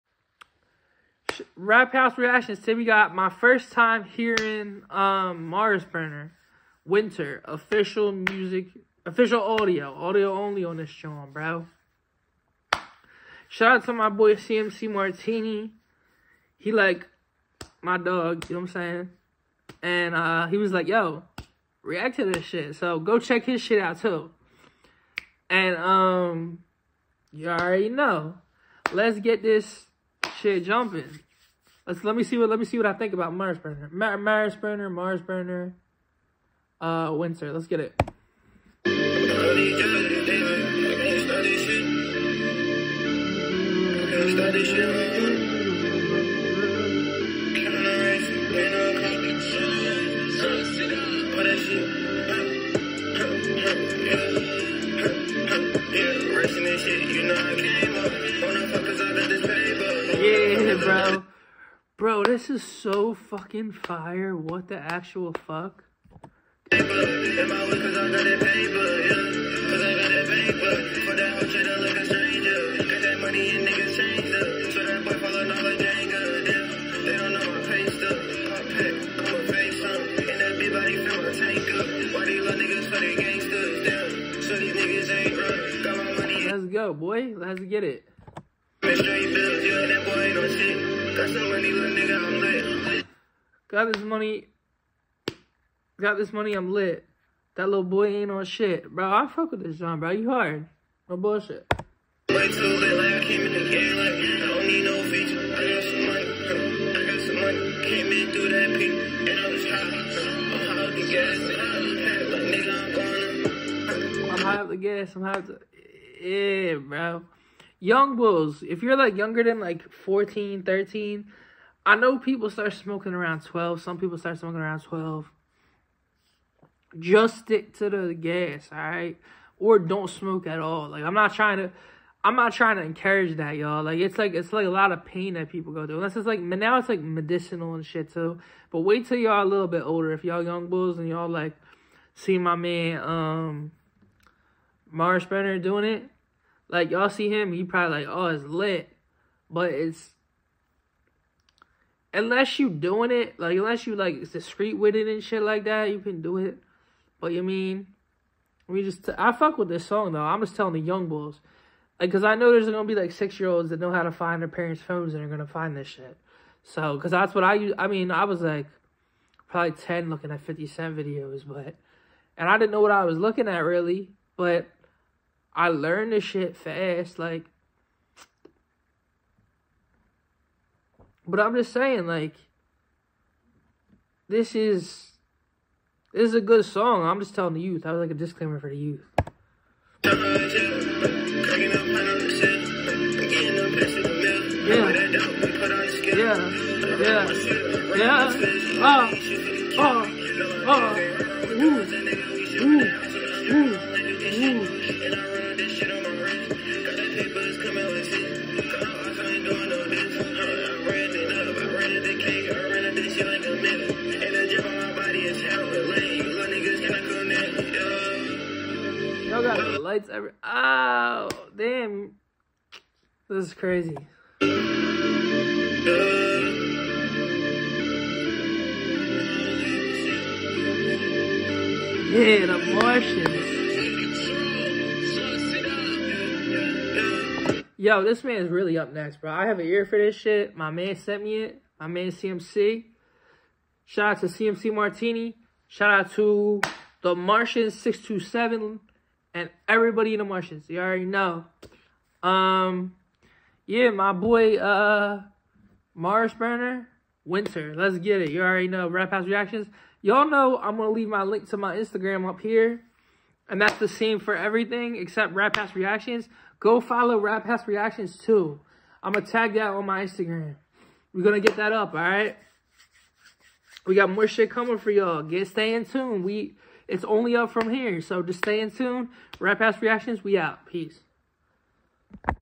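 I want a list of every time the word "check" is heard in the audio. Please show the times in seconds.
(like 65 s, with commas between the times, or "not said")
23 s.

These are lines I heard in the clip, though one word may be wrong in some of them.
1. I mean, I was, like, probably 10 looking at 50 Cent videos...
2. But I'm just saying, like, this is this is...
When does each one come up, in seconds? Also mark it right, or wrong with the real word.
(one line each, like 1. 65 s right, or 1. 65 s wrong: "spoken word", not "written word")
1. 167 s right
2. 181 s right.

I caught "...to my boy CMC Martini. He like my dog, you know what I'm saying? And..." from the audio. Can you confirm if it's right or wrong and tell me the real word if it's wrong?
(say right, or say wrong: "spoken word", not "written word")
right.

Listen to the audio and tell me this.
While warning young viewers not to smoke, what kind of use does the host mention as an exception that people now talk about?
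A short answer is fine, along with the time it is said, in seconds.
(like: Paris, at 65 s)
medicinal, at 137 s.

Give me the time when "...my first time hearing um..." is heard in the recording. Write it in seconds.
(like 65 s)
3 s.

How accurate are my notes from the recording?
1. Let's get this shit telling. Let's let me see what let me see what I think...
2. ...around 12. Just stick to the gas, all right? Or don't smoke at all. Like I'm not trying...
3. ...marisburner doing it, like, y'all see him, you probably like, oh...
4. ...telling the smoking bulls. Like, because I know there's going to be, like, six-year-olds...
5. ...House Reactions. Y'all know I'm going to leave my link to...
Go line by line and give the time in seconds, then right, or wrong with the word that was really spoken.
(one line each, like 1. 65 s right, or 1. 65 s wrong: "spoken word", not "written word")
1. 28 s wrong: "jumping", not "telling"
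2. 124 s right
3. 144 s right
4. 160 s wrong: "young", not "smoking"
5. 259 s right.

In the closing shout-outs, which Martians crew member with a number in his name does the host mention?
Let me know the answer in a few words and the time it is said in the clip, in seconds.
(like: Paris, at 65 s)
the Martian 627, at 247 s.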